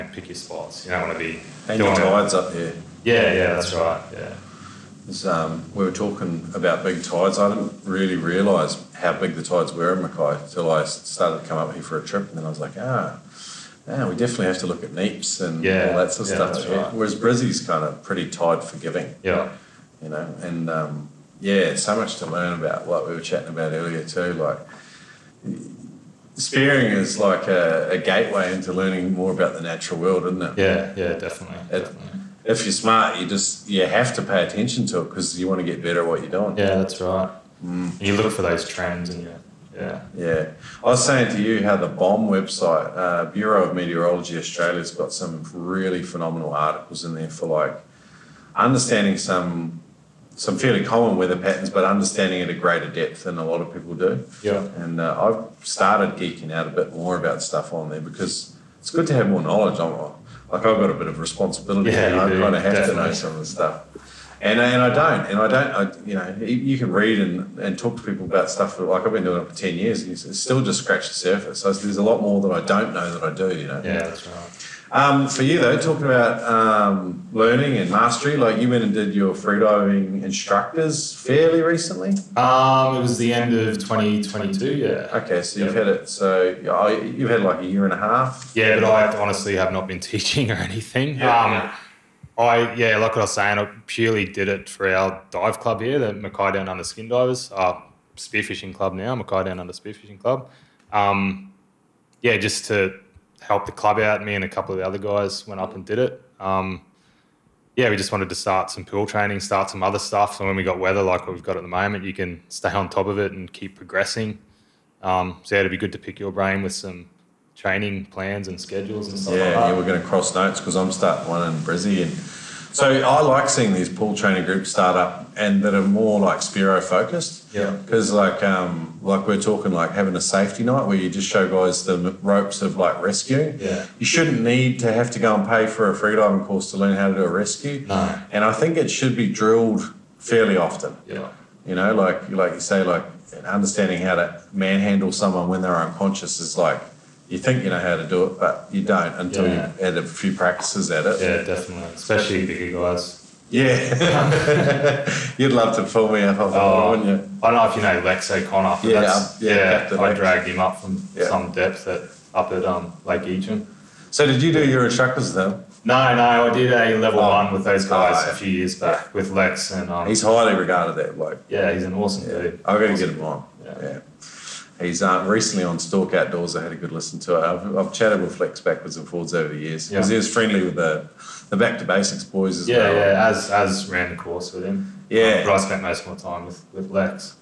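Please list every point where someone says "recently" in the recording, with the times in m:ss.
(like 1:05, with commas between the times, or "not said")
1:21, 2:55.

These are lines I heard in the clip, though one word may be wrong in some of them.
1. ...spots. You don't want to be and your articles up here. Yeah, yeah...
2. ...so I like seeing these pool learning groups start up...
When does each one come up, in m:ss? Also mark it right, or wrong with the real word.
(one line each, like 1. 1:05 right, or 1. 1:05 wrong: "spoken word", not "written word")
1. 0:00 wrong: "tides", not "articles"
2. 2:02 wrong: "training", not "learning".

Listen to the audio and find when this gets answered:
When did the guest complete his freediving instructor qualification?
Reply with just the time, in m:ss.
1:23.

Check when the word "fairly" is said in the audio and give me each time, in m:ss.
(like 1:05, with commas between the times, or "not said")
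0:50, 1:21, 2:20.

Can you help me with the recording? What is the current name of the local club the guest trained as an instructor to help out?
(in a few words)
Mackay Down Under Spearfishing Club.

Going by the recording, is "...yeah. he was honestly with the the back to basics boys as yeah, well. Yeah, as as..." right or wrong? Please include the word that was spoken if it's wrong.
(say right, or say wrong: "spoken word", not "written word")
wrong: "friendly", not "honestly".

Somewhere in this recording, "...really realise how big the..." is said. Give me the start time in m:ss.
0:07.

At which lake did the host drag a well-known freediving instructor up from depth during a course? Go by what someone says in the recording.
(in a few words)
Lake Eacham.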